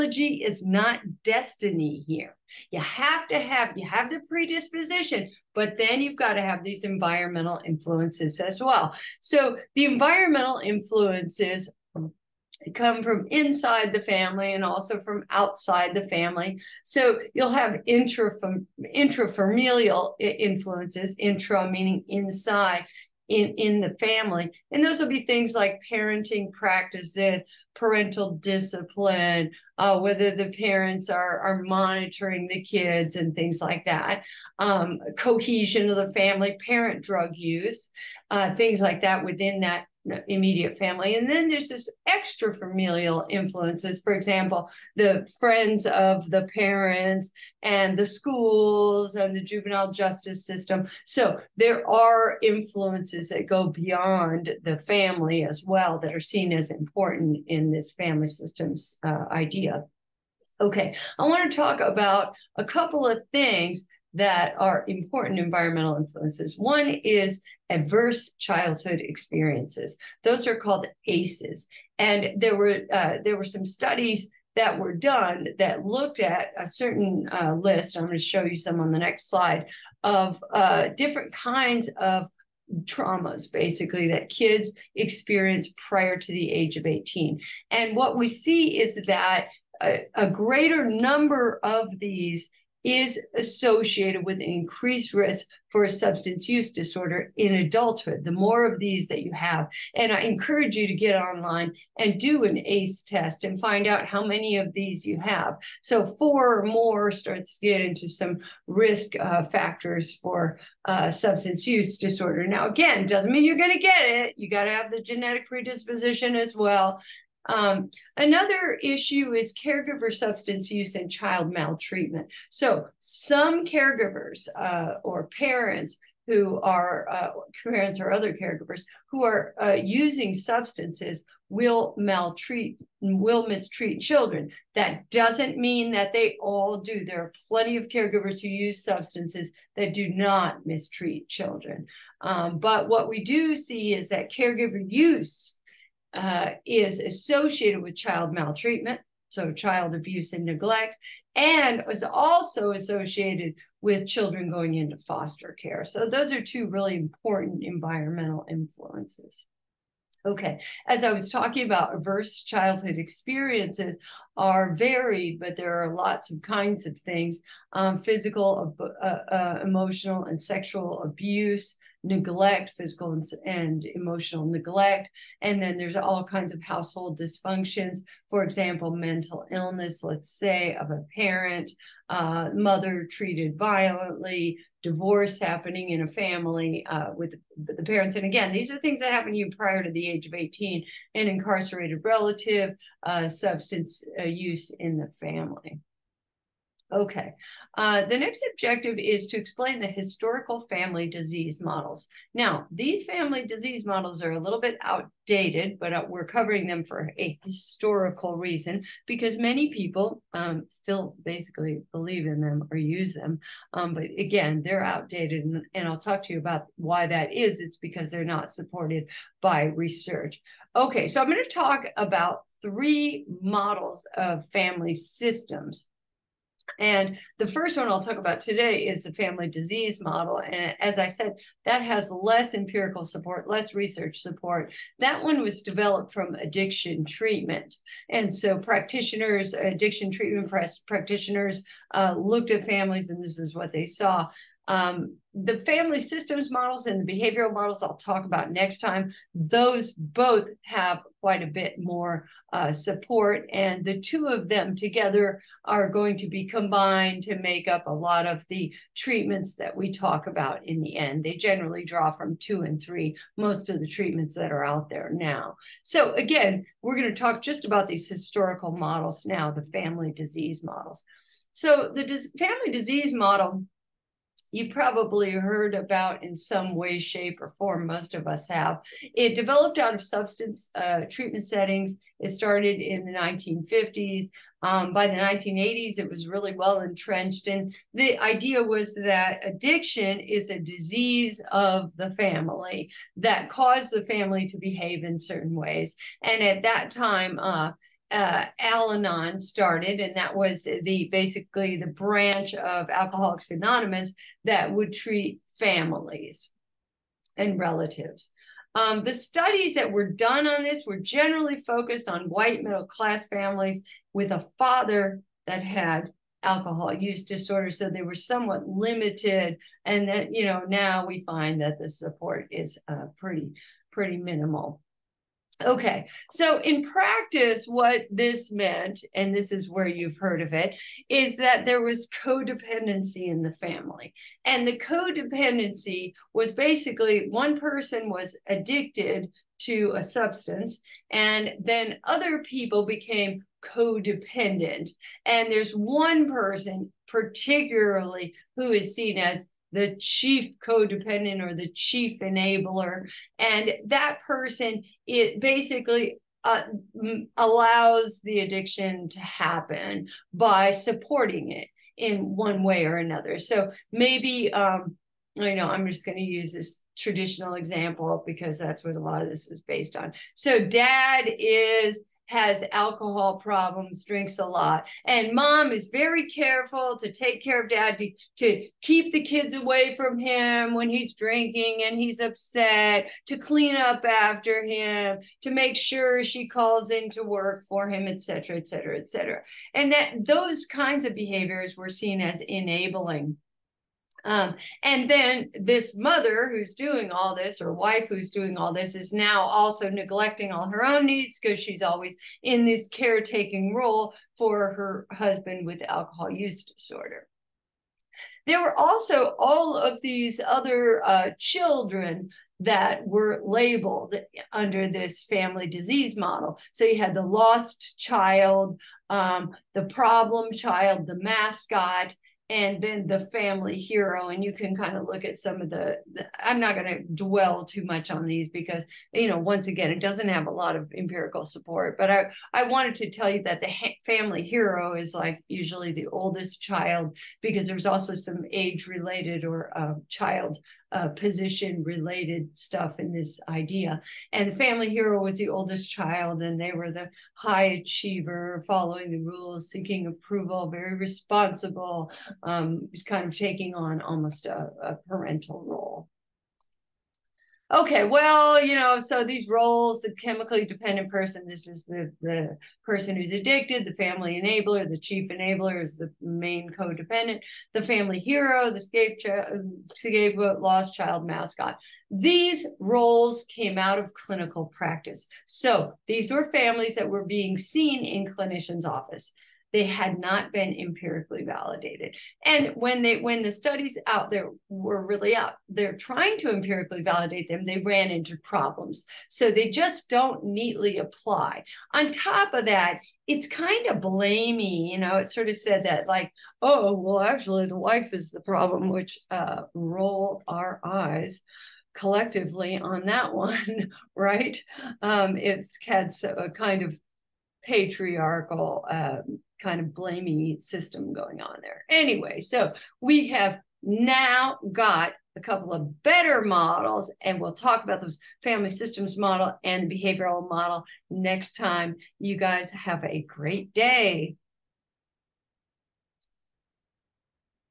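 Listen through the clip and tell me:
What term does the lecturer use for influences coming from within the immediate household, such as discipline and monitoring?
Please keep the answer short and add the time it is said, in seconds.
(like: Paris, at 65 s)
intrafamilial influences, at 18 s.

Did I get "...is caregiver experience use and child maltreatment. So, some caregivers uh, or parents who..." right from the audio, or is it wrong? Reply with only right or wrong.
wrong.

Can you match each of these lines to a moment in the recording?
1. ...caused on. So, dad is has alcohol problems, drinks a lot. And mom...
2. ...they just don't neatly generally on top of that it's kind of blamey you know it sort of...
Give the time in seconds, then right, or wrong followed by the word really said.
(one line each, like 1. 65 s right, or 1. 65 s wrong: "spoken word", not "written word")
1. 369 s wrong: "based", not "caused"
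2. 489 s wrong: "apply", not "generally".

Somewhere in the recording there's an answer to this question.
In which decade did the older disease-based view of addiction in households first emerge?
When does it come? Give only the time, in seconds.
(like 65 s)
283 s.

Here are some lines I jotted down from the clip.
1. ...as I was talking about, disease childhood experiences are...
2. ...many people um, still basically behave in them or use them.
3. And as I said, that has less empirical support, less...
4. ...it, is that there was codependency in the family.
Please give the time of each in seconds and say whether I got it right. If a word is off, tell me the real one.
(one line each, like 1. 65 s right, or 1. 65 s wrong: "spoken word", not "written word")
1. 160 s wrong: "adverse", not "disease"
2. 209 s wrong: "believe", not "behave"
3. 230 s right
4. 330 s right.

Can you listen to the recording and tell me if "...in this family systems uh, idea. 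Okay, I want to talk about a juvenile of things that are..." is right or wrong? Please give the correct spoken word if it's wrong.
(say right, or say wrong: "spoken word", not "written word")
wrong: "couple", not "juvenile".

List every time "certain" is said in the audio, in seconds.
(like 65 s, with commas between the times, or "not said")
76 s, 295 s.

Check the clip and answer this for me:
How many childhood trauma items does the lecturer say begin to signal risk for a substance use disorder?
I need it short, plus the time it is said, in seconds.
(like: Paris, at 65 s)
4 or more, at 106 s.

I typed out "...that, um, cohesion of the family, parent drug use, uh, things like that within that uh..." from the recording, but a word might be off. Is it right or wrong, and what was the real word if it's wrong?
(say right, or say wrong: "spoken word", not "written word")
right.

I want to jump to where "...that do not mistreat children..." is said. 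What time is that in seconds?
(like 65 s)
139 s.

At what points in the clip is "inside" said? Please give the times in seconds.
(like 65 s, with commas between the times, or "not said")
13 s, 22 s.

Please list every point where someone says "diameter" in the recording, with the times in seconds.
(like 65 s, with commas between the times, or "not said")
not said.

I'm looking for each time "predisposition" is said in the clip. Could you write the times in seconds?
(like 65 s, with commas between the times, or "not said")
4 s, 115 s.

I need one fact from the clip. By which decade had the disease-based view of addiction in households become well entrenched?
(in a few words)
1980s.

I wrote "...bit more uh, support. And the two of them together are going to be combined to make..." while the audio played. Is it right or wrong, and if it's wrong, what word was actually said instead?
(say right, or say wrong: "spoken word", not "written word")
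right.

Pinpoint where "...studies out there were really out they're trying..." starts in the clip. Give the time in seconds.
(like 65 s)
483 s.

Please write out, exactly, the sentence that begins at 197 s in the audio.
Uh, the next objective is to explain the historical family disease models.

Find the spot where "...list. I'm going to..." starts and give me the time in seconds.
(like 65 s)
77 s.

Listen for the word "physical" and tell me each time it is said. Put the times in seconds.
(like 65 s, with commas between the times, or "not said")
167 s, 172 s.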